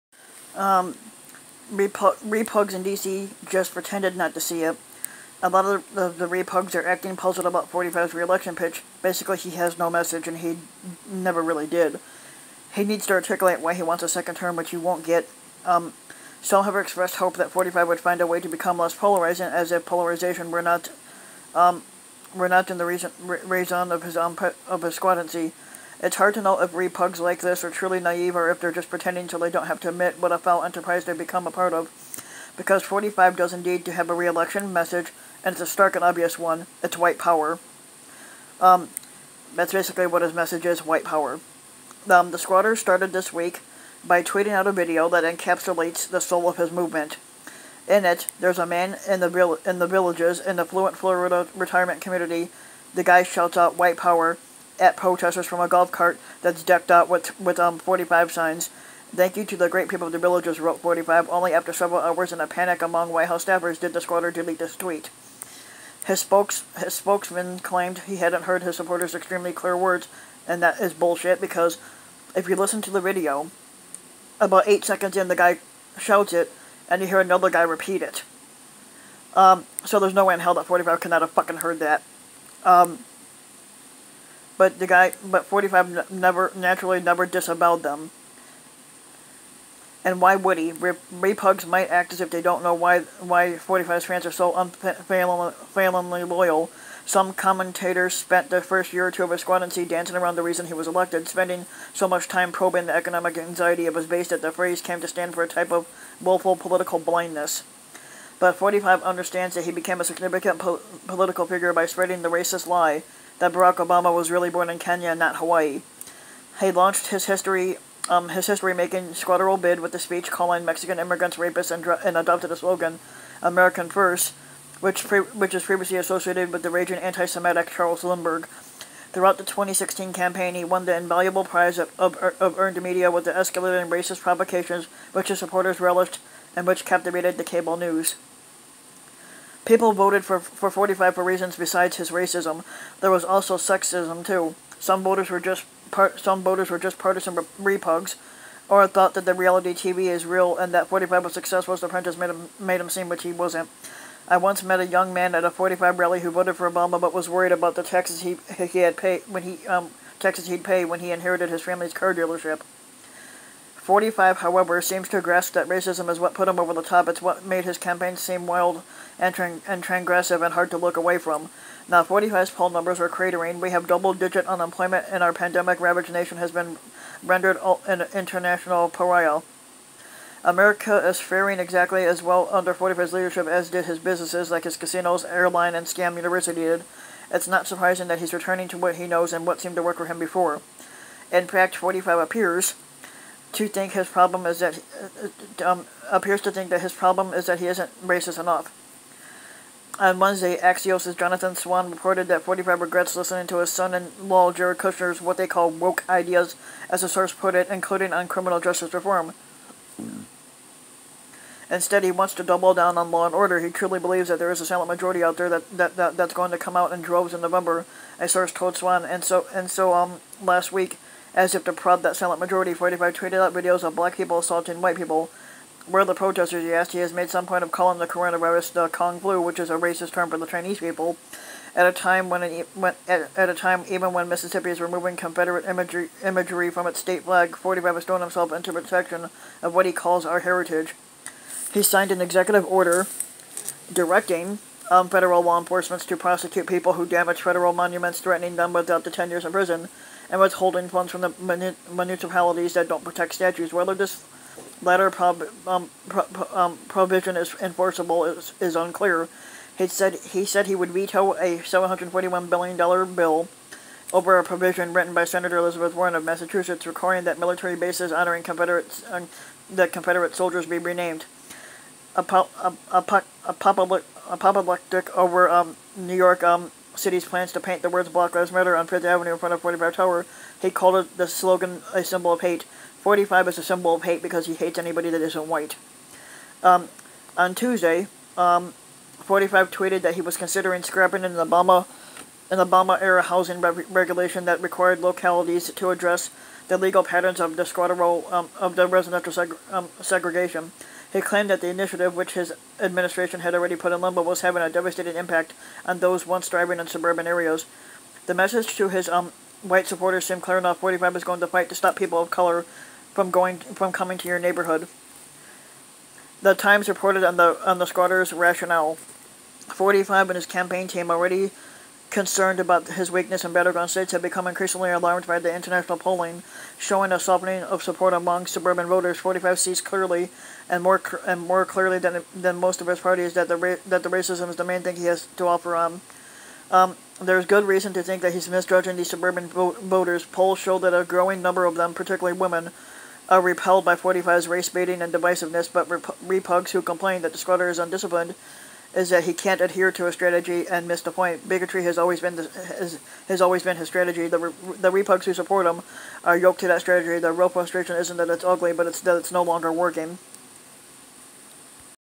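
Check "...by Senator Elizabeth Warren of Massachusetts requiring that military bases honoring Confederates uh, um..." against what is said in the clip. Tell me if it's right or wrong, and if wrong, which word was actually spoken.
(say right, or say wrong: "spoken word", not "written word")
right.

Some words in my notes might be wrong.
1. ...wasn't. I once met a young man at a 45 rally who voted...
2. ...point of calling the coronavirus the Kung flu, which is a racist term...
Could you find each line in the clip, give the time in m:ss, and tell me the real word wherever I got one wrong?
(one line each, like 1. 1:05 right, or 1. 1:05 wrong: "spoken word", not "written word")
1. 2:33 right
2. 3:47 right.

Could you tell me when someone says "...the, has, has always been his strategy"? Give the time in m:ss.
5:52.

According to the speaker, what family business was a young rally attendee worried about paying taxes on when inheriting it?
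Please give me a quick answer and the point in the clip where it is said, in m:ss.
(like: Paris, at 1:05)
car dealership, at 2:41.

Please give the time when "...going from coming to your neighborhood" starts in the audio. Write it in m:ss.
5:13.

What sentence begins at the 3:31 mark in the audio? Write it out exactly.
Instead, he wants to double down on law and order.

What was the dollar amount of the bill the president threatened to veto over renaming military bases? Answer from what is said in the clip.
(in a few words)
$741 billion.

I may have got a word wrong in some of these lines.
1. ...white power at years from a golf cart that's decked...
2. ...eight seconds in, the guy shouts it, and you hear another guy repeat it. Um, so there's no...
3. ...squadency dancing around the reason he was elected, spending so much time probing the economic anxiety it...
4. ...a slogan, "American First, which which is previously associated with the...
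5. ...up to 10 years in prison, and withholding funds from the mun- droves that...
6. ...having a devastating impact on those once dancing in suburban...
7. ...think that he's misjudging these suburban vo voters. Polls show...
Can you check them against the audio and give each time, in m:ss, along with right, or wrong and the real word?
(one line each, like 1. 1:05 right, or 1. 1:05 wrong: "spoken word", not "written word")
1. 0:53 wrong: "protesters", not "years"
2. 1:14 right
3. 1:39 right
4. 2:02 right
5. 4:08 wrong: "municipalities", not "droves"
6. 5:04 wrong: "thriving", not "dancing"
7. 5:38 right.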